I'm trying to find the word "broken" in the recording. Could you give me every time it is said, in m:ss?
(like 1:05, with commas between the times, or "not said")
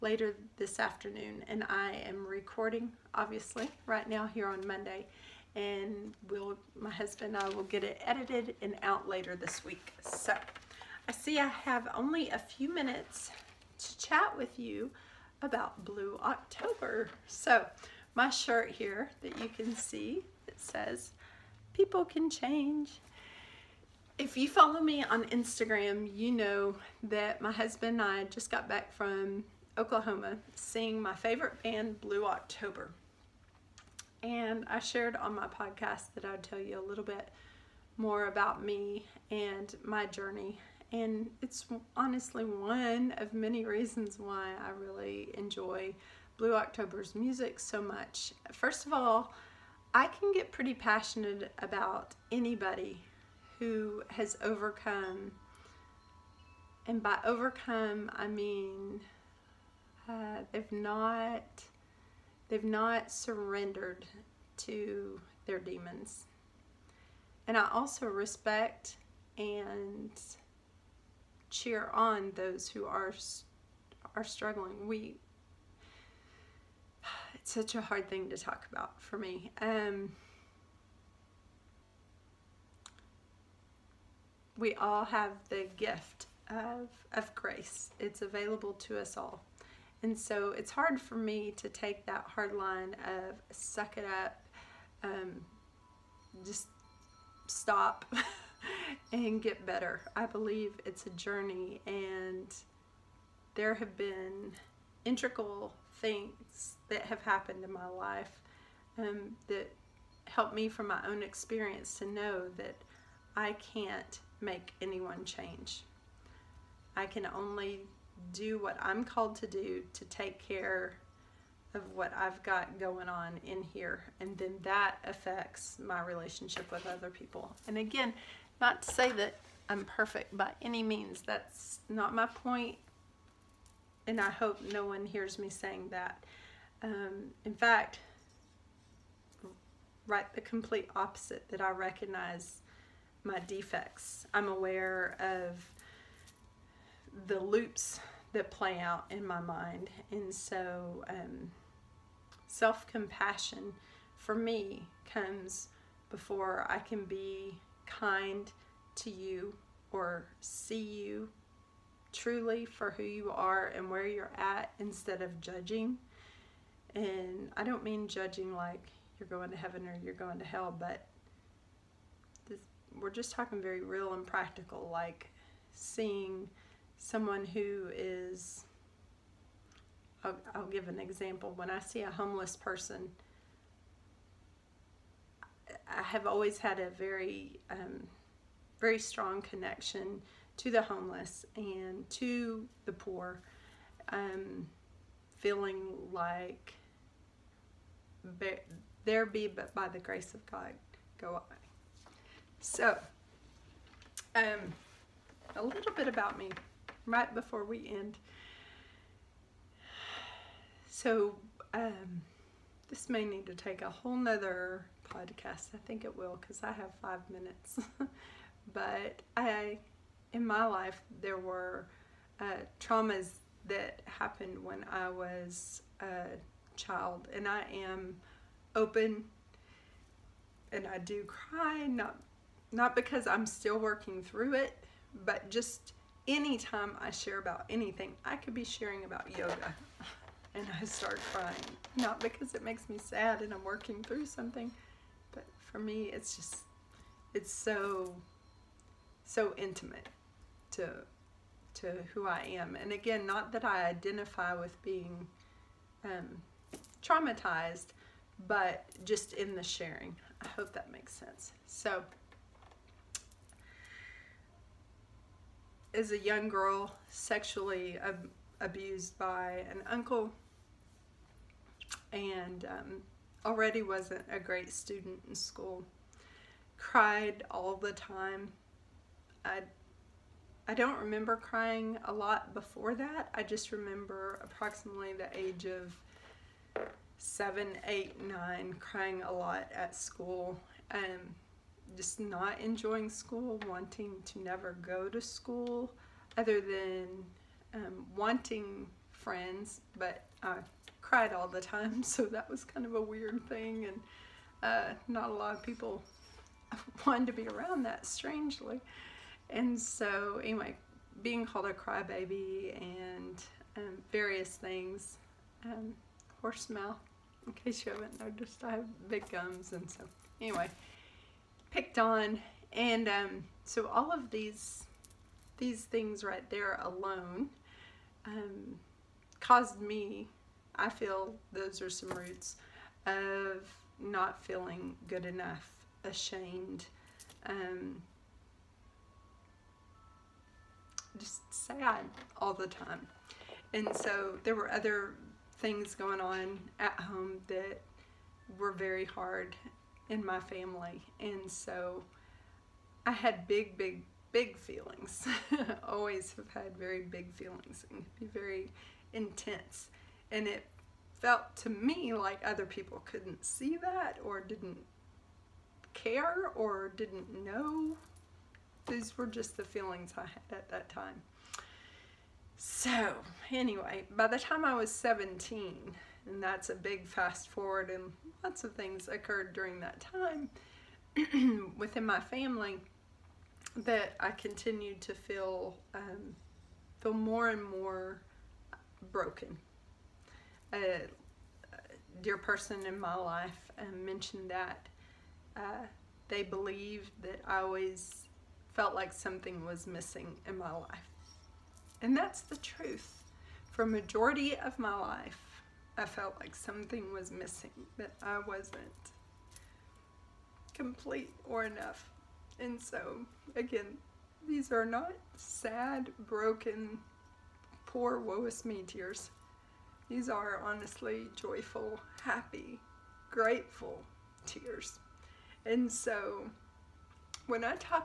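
6:29, 6:56.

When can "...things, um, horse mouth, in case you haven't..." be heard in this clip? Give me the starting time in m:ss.
5:14.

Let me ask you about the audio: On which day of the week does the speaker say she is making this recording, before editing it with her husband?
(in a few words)
Monday.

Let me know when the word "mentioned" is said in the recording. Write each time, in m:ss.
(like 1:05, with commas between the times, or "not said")
6:34.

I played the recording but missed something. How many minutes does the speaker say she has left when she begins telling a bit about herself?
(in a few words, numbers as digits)
5.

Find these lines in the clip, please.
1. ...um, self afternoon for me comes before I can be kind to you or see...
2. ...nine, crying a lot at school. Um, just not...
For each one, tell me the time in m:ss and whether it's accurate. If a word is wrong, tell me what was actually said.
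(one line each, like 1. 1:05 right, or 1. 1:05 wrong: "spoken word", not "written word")
1. 2:31 wrong: "compassion", not "afternoon"
2. 4:48 right.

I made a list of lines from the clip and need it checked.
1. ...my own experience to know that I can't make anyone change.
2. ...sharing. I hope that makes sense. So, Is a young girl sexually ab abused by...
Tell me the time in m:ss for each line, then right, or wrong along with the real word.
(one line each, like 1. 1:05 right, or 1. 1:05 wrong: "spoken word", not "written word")
1. 1:50 right
2. 4:19 right.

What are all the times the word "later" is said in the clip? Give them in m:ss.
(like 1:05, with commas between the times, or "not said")
0:00, 0:09.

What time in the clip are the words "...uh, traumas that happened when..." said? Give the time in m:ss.
3:42.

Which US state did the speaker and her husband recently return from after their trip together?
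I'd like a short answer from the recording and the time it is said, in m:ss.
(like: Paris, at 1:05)
Oklahoma, at 0:29.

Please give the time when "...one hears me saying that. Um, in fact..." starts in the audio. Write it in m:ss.
2:14.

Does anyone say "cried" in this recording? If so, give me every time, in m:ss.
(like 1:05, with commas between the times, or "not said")
4:36, 5:01.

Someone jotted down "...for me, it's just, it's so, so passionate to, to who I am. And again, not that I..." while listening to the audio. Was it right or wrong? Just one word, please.
wrong.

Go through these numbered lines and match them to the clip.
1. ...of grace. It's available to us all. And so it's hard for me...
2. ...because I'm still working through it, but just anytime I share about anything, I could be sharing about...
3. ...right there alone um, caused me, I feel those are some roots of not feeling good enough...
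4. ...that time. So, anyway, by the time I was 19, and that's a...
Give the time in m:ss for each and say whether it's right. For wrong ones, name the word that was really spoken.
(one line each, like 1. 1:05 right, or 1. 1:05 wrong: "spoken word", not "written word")
1. 1:27 right
2. 3:52 right
3. 5:26 right
4. 6:10 wrong: "17", not "19".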